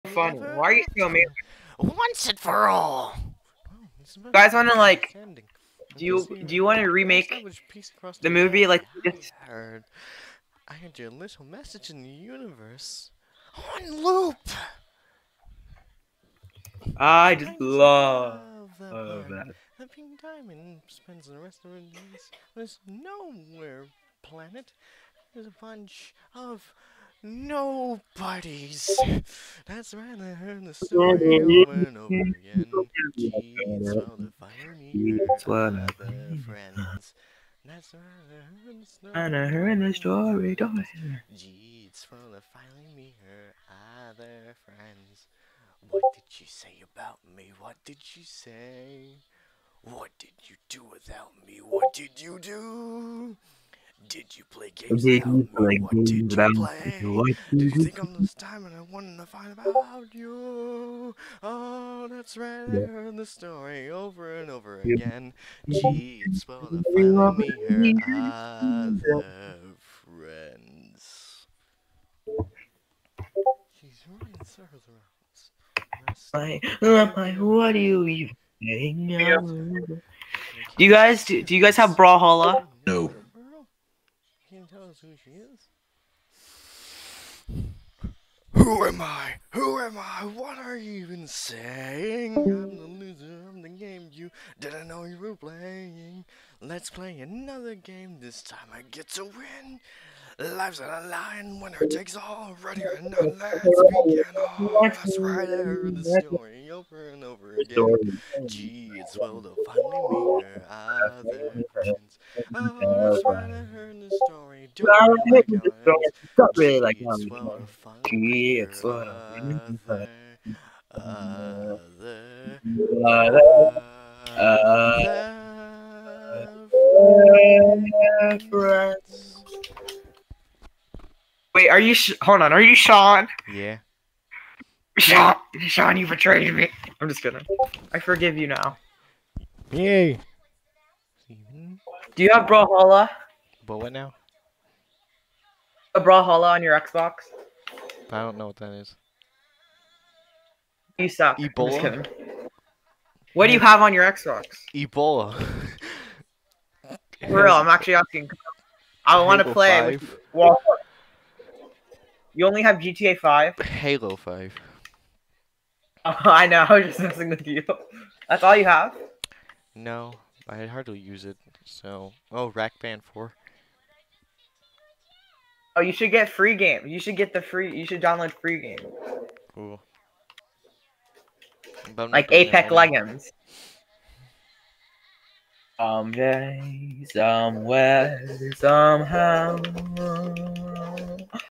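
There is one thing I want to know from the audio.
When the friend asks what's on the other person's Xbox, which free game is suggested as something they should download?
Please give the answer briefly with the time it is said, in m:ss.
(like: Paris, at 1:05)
Apex Legends, at 3:02.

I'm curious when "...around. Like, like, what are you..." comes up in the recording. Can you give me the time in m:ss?
1:14.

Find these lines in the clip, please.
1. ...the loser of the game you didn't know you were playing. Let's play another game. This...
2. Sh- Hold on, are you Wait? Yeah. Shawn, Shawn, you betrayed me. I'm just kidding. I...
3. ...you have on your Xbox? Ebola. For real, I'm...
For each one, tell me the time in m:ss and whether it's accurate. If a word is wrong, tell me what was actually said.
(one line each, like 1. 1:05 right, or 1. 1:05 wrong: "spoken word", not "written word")
1. 1:32 right
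2. 2:11 wrong: "Shawn", not "Wait"
3. 2:33 right.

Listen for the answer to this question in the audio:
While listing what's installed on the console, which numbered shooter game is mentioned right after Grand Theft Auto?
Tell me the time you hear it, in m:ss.
2:43.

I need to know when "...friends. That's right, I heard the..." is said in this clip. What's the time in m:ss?
0:36.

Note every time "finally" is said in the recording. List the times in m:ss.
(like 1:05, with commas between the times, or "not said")
1:49, 1:59.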